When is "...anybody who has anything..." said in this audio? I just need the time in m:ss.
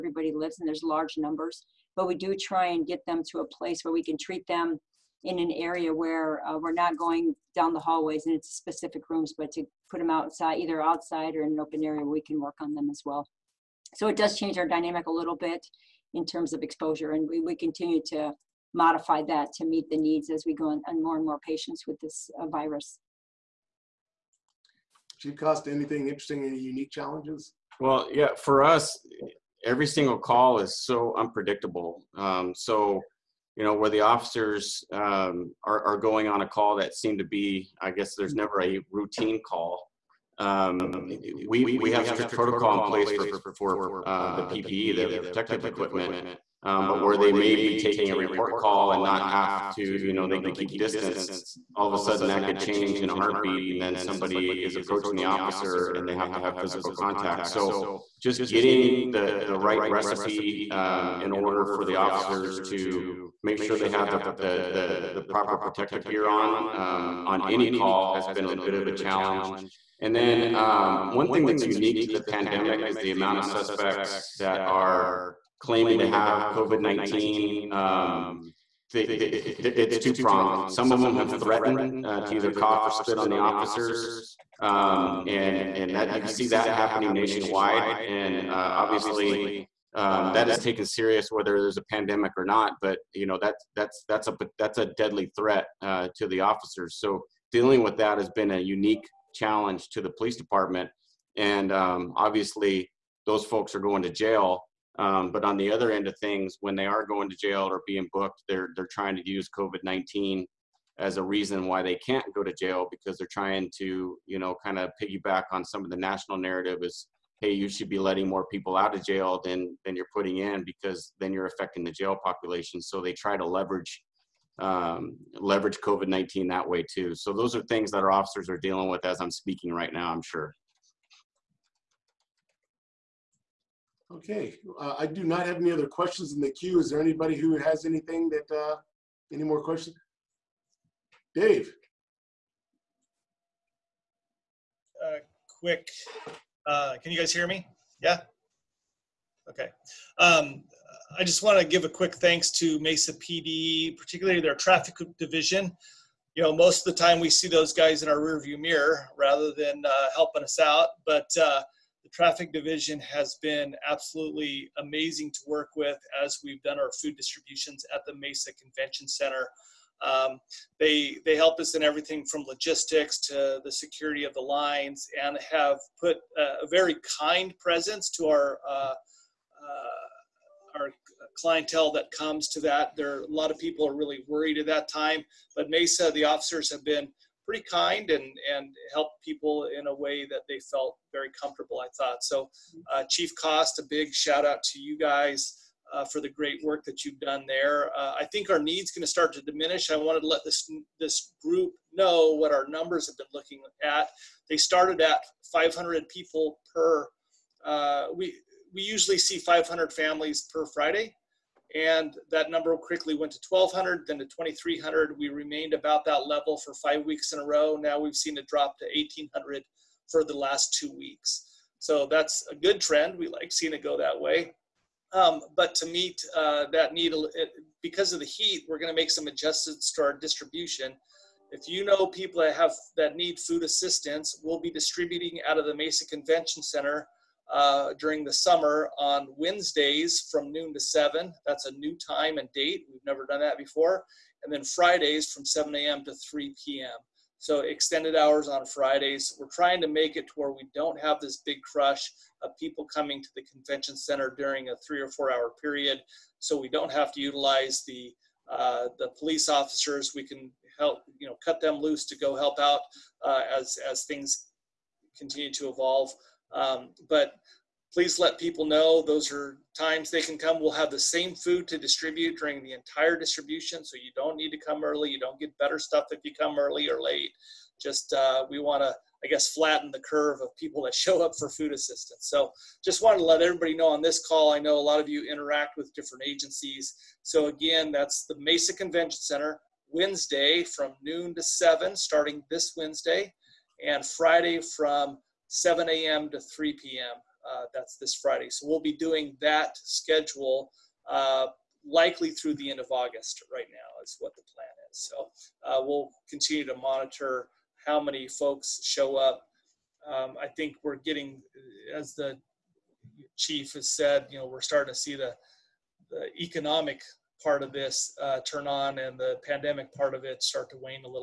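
2:17.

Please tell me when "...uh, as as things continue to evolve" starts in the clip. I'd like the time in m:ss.
4:23.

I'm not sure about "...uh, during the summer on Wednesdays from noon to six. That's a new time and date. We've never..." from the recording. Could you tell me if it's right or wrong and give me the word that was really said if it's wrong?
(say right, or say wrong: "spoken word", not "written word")
wrong: "seven", not "six".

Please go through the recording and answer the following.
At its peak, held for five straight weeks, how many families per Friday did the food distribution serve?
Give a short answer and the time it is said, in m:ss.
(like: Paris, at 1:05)
2,300, at 3:34.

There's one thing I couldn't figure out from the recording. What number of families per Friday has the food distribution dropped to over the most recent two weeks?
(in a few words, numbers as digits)
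1,800.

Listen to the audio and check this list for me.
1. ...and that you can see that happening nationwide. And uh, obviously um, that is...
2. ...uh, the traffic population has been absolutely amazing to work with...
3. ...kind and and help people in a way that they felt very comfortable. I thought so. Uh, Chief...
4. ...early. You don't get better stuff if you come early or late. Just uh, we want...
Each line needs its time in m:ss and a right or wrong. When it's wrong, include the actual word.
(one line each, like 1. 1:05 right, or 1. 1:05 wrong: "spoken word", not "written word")
1. 1:25 right
2. 2:41 wrong: "division", not "population"
3. 3:07 right
4. 4:34 right.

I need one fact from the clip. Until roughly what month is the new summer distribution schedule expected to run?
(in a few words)
August.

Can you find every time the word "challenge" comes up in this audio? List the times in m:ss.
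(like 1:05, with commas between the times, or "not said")
0:26, 1:08, 1:39.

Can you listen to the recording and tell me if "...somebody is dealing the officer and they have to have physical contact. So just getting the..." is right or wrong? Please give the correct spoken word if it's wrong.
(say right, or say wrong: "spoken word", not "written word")
wrong: "approaching", not "dealing".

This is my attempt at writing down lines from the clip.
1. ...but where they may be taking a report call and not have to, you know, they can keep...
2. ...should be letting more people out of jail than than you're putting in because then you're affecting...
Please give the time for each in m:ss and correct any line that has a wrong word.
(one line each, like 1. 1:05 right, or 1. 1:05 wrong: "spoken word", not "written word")
1. 0:46 right
2. 1:57 right.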